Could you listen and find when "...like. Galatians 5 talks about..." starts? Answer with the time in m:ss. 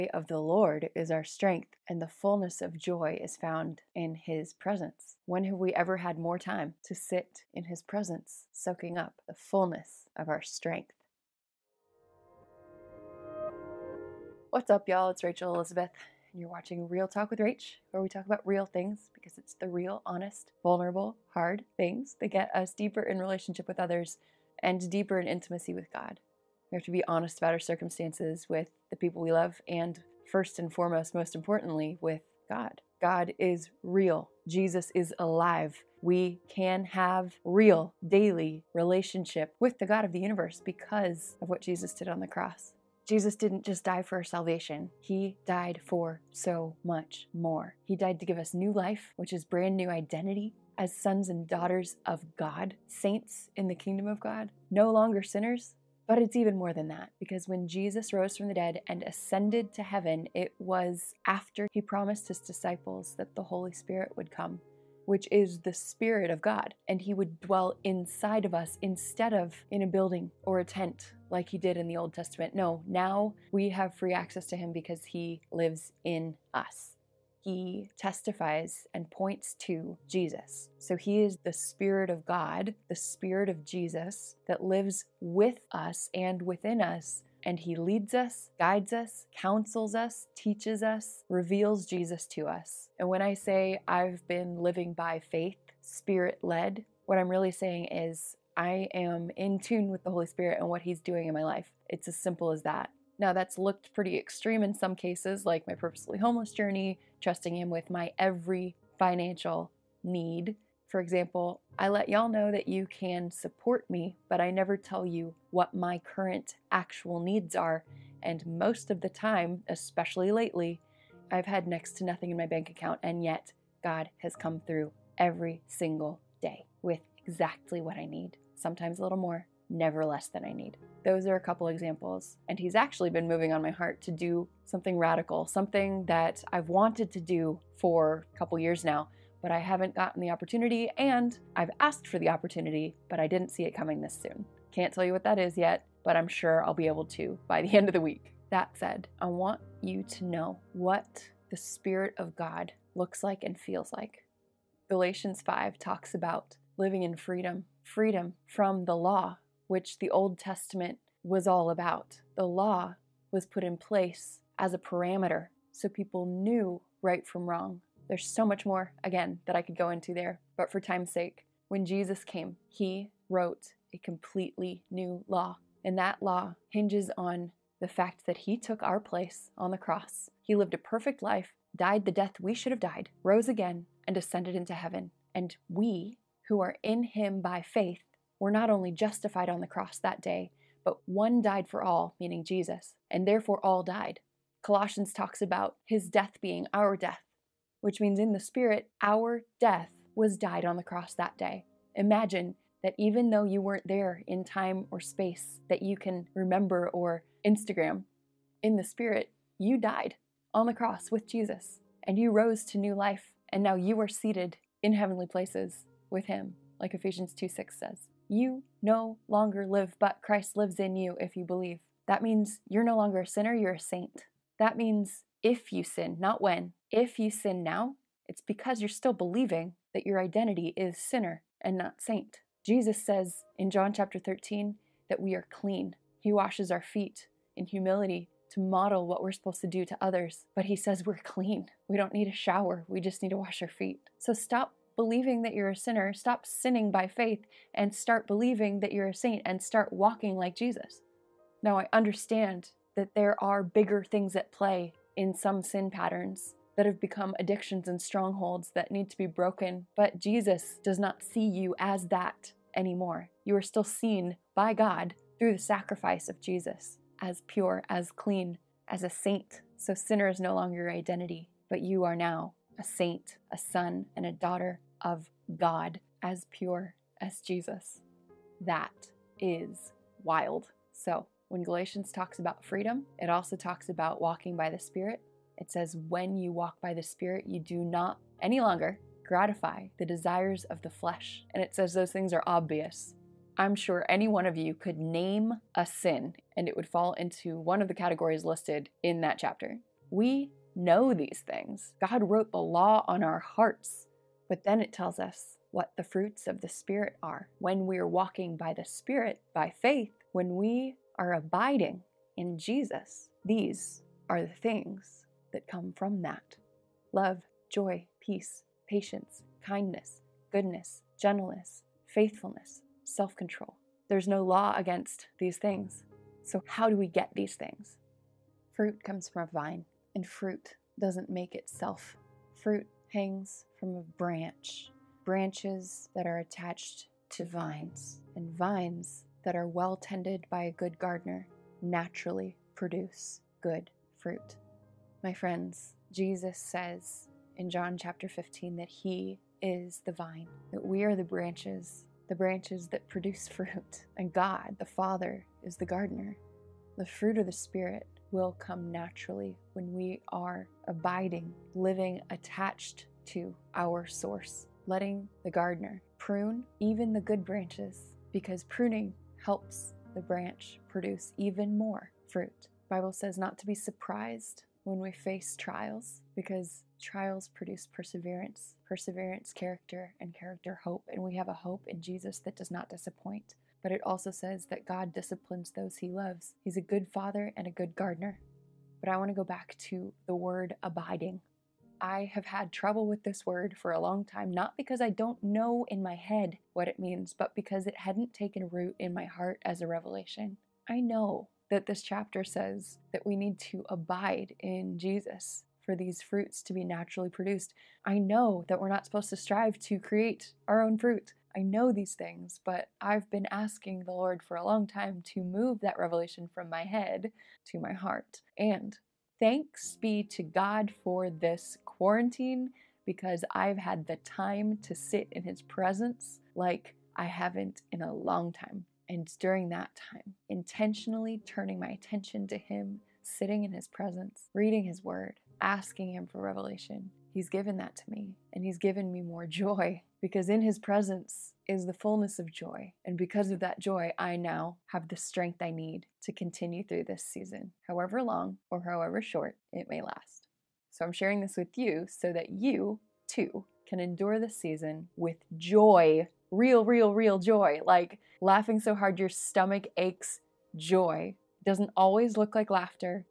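2:33.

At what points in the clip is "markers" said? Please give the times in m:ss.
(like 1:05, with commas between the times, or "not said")
not said.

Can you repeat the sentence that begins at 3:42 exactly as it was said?
That means you're no longer a sinner, you're a saint.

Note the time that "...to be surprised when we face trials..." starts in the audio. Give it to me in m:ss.
6:13.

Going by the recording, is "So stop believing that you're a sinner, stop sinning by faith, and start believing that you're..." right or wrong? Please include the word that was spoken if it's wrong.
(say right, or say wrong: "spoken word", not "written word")
right.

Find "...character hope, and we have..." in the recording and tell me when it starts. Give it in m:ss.
6:20.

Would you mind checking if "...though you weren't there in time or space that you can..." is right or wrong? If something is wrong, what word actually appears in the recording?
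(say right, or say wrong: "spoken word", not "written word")
right.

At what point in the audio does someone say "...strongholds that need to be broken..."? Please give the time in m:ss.
4:18.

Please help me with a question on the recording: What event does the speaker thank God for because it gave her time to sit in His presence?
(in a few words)
quarantine.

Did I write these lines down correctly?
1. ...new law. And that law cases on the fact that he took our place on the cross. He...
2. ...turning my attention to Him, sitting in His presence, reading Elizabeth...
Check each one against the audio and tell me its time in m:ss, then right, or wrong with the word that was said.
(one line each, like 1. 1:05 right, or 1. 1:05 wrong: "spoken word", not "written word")
1. 2:54 wrong: "hinges", not "cases"
2. 7:11 wrong: "His", not "Elizabeth".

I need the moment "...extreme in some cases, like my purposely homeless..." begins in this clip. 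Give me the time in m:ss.
1:44.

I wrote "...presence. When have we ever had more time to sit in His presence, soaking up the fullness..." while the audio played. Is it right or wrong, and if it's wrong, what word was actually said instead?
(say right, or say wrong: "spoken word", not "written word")
right.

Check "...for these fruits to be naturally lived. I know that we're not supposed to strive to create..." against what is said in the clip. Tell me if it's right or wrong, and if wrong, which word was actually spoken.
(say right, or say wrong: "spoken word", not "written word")
wrong: "produced", not "lived".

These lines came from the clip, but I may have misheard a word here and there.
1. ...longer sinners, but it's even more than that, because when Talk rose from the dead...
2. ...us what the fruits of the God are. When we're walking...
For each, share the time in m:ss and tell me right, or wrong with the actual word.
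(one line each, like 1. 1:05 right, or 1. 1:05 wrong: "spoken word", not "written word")
1. 0:54 wrong: "Jesus", not "Talk"
2. 5:05 wrong: "Spirit", not "God".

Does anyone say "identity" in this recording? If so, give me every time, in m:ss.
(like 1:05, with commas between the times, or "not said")
0:49, 3:50, 4:30.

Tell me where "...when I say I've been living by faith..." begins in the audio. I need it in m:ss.
1:33.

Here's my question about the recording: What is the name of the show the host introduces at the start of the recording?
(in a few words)
Real Talk with Rach.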